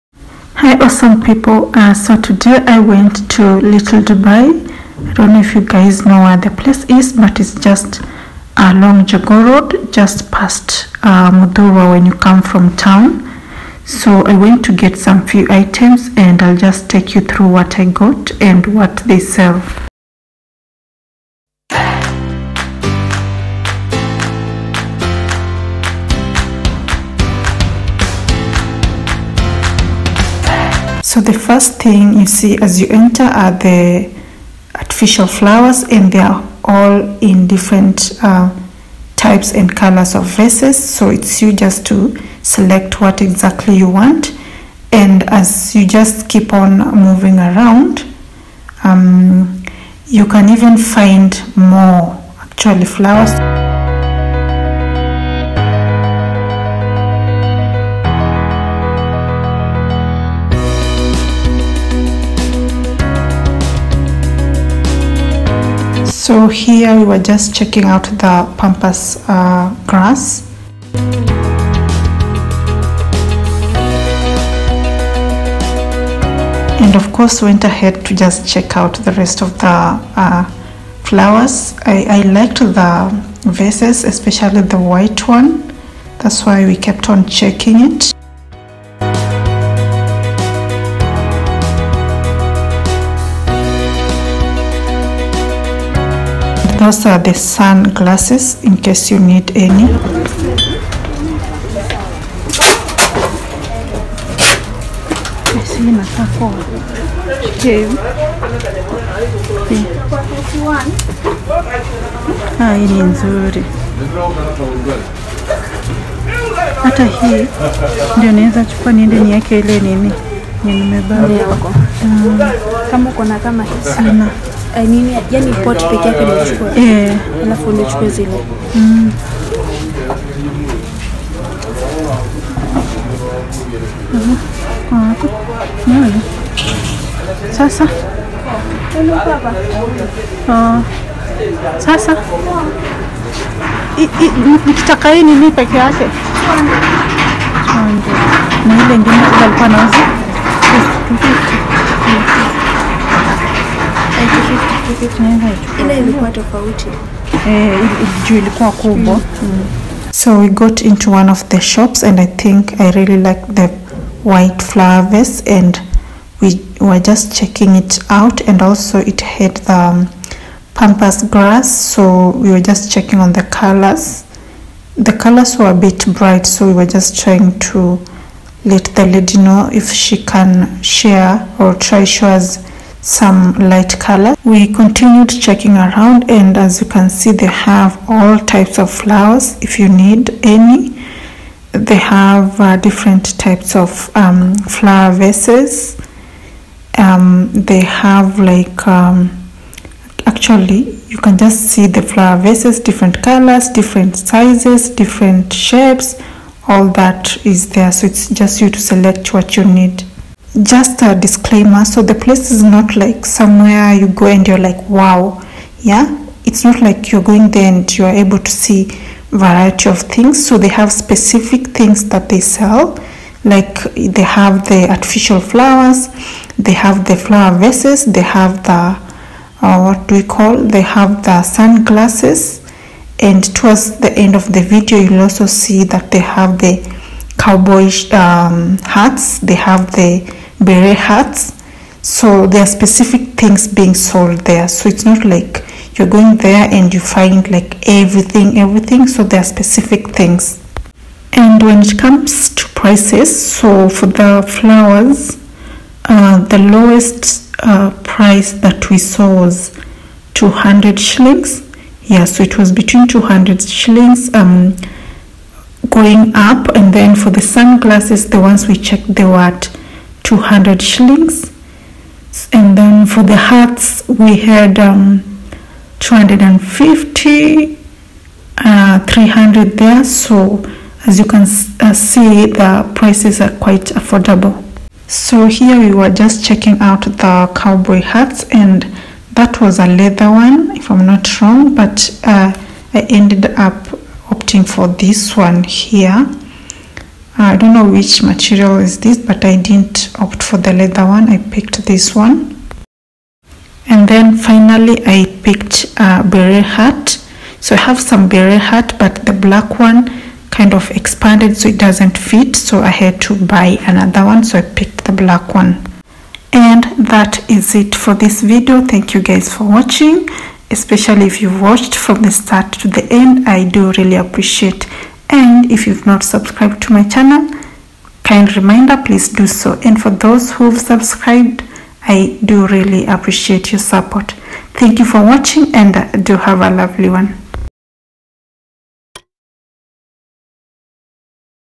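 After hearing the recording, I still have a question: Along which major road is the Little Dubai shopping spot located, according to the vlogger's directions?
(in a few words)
Jogoo Road.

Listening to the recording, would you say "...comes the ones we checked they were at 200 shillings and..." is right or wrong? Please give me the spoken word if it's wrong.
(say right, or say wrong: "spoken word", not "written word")
wrong: "sunglasses", not "comes".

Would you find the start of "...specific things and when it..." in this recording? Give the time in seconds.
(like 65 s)
249 s.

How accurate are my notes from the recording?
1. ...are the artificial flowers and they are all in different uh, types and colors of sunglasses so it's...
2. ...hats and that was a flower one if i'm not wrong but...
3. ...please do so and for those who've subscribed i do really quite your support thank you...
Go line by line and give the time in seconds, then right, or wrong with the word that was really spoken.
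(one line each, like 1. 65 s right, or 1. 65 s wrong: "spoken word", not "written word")
1. 33 s wrong: "vases", not "sunglasses"
2. 288 s wrong: "leather", not "flower"
3. 329 s wrong: "appreciate", not "quite".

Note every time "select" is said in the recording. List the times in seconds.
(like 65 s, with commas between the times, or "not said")
42 s, 208 s.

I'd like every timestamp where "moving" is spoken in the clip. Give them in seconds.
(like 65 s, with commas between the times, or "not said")
46 s.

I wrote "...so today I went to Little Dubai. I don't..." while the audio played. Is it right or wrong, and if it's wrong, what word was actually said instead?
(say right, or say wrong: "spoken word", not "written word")
right.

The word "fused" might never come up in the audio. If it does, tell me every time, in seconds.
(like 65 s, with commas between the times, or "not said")
not said.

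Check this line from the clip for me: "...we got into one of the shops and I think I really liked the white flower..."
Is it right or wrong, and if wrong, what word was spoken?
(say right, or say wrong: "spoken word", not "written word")
right.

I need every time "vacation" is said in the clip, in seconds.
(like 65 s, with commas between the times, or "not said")
not said.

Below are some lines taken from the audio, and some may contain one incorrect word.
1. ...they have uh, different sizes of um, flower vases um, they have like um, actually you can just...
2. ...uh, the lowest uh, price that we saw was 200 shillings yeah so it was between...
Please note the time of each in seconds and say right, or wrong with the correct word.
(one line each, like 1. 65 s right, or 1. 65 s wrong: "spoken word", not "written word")
1. 191 s wrong: "types", not "sizes"
2. 256 s right.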